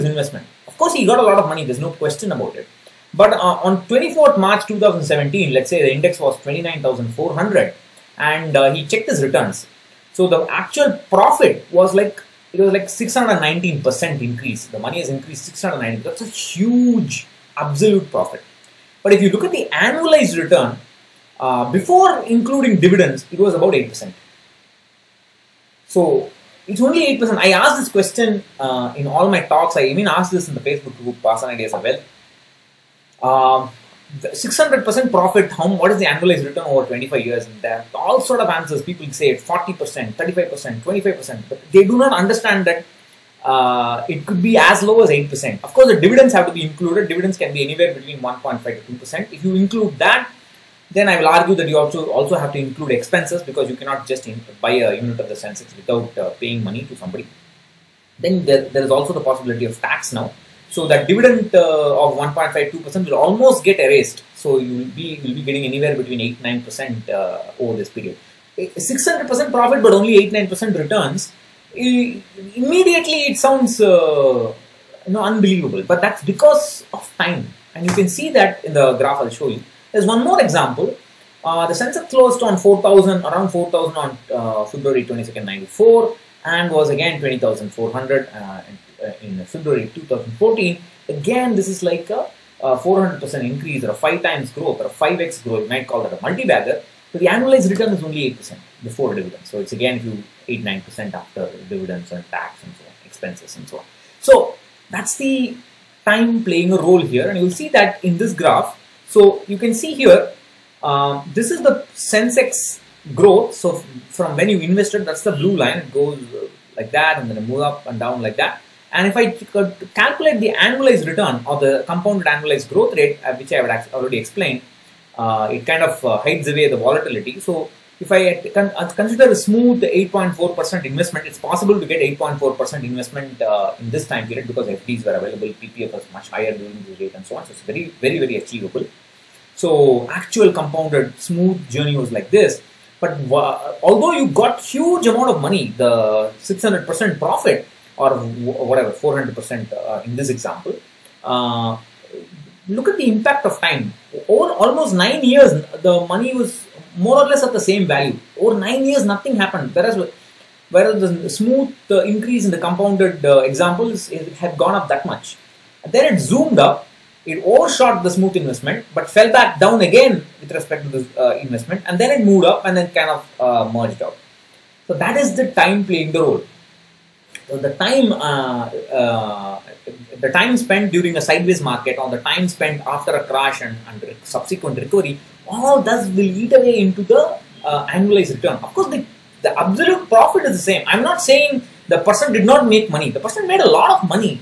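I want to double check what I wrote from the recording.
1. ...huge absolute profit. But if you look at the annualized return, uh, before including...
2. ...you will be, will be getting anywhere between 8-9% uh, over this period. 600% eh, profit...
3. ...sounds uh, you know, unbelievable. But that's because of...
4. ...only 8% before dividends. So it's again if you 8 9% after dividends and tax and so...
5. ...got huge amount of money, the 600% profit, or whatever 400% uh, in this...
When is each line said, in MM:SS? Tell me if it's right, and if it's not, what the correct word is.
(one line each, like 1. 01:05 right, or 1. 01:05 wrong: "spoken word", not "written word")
1. 00:16 right
2. 01:04 right
3. 01:13 right
4. 01:38 right
5. 02:24 right.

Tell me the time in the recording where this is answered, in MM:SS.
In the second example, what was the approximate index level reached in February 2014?
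01:27.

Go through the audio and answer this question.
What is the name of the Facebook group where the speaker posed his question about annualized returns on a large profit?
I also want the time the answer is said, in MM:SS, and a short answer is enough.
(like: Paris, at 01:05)
Asan Ideas of Wealth, at 00:31.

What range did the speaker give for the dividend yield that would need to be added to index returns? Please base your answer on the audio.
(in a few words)
1.5 to 2%.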